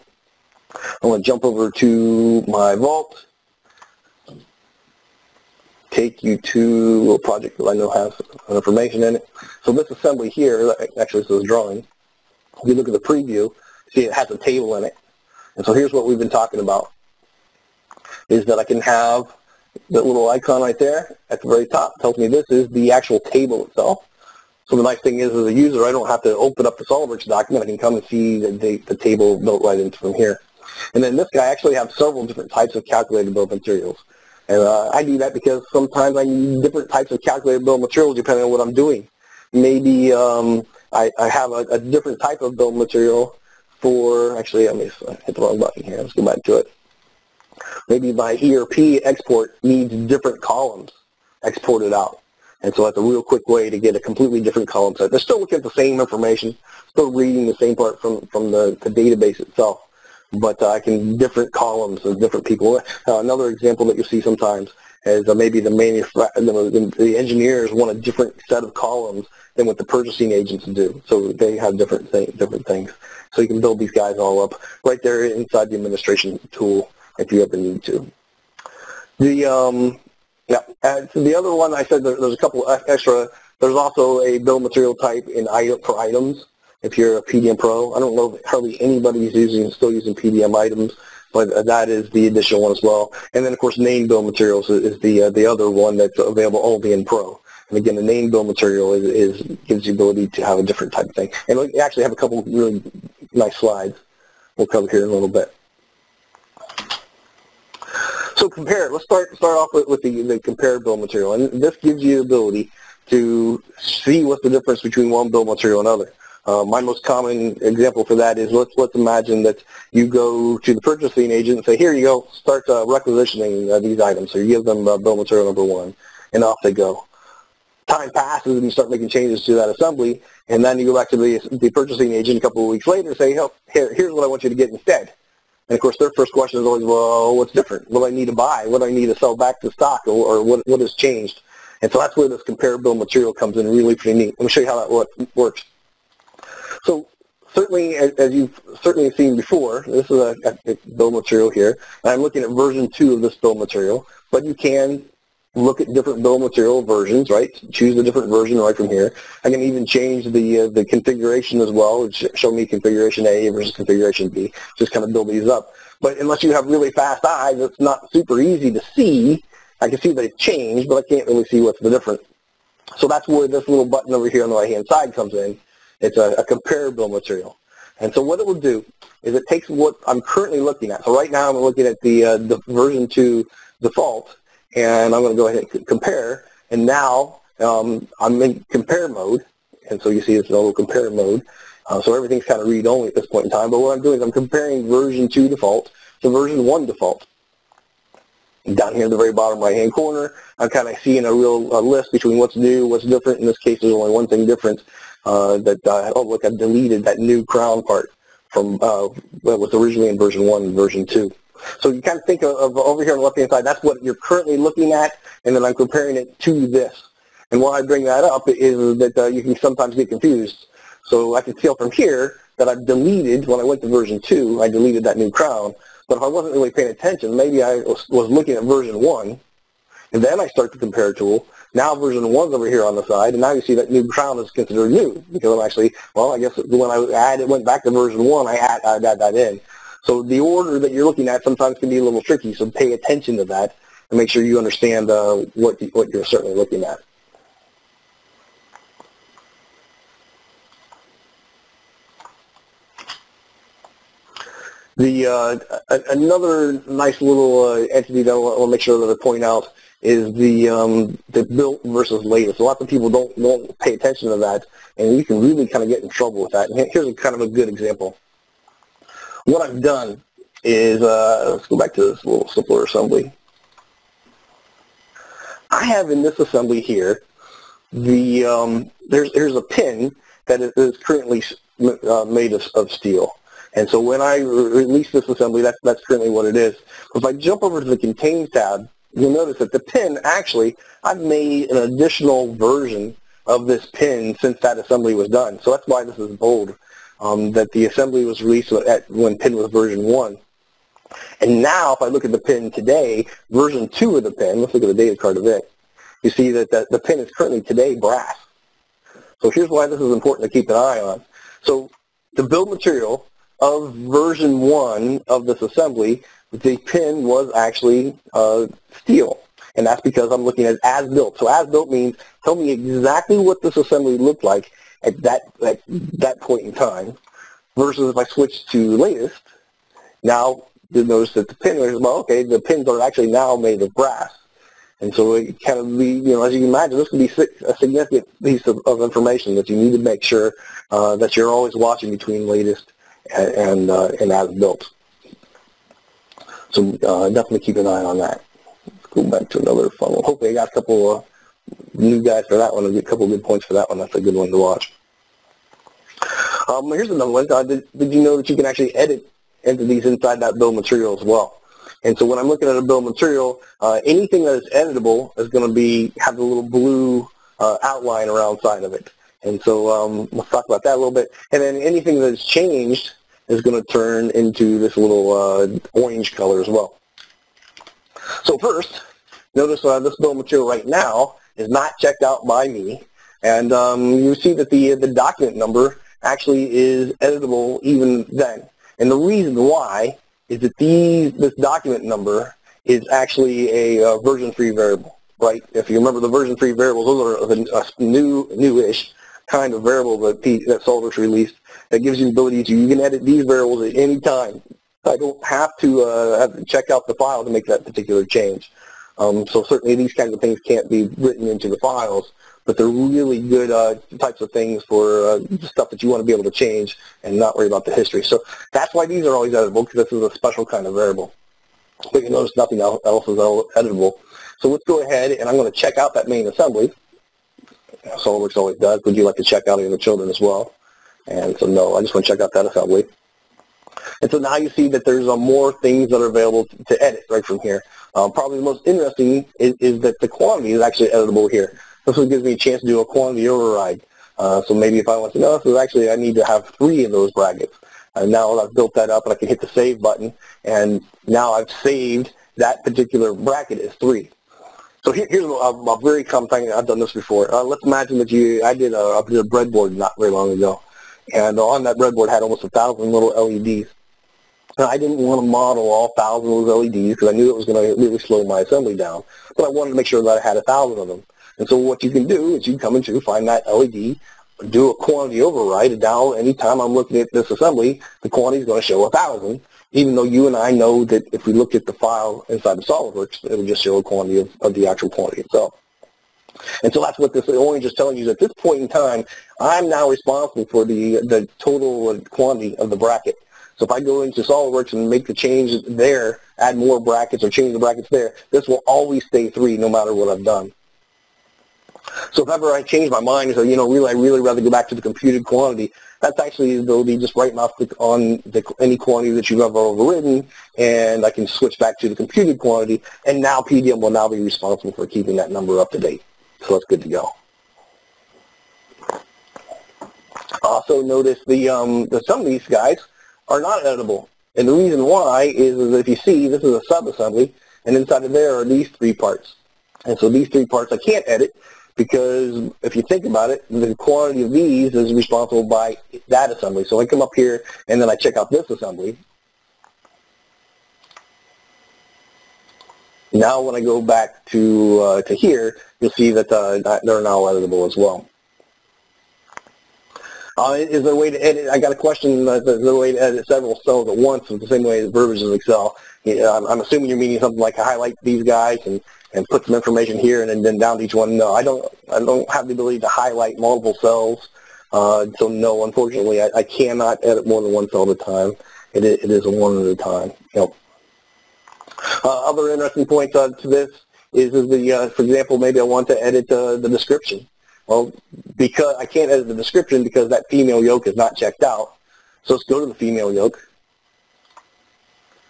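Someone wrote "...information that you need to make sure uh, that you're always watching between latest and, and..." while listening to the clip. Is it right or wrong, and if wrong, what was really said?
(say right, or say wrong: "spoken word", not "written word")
right.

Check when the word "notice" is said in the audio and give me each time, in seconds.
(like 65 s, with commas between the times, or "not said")
289 s, 331 s, 379 s, 422 s, 521 s.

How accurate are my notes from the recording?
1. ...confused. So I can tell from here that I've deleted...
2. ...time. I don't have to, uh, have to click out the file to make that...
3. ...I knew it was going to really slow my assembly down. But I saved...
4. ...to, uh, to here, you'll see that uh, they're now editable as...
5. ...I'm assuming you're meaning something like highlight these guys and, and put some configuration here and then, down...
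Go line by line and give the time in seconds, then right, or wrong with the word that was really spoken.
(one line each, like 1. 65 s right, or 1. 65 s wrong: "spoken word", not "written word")
1. 220 s right
2. 404 s wrong: "check", not "click"
3. 467 s wrong: "wanted", not "saved"
4. 544 s right
5. 556 s wrong: "information", not "configuration".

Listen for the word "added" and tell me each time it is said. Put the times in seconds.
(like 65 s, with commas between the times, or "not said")
237 s.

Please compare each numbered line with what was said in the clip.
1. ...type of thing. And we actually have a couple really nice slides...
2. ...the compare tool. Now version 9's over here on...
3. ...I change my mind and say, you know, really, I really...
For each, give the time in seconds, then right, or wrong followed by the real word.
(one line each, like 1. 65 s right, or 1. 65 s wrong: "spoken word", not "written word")
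1. 100 s right
2. 230 s wrong: "1", not "9"
3. 502 s right.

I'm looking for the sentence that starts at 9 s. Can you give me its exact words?
So this assembly here, actually this is a drawing, if you look at the preview, see it has a table in it.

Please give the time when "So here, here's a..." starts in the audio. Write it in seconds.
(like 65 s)
455 s.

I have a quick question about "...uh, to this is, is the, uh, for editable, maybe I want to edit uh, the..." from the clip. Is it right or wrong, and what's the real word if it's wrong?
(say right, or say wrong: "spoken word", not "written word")
wrong: "example", not "editable".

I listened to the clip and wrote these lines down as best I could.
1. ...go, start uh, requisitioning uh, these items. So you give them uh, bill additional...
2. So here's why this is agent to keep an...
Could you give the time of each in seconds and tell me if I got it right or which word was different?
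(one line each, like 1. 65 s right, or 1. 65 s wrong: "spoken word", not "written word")
1. 122 s wrong: "material", not "additional"
2. 309 s wrong: "important", not "agent".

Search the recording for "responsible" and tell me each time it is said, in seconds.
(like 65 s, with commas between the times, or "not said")
490 s, 514 s, 535 s.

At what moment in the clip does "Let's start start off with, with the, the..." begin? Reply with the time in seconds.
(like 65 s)
108 s.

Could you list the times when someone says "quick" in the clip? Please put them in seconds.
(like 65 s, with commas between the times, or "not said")
53 s.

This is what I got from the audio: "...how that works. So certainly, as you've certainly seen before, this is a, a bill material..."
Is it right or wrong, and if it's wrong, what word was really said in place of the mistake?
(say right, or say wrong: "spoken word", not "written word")
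right.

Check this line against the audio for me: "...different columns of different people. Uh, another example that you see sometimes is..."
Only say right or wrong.
right.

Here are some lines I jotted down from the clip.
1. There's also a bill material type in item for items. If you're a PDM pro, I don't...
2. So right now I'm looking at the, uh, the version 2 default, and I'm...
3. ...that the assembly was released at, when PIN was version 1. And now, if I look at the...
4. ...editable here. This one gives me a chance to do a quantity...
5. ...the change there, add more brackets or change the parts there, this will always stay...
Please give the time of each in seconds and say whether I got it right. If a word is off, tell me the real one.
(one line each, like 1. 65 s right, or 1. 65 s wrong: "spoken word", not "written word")
1. 83 s right
2. 181 s right
3. 297 s right
4. 441 s right
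5. 495 s wrong: "brackets", not "parts".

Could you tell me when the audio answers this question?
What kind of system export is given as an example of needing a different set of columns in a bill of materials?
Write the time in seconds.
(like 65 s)
48 s.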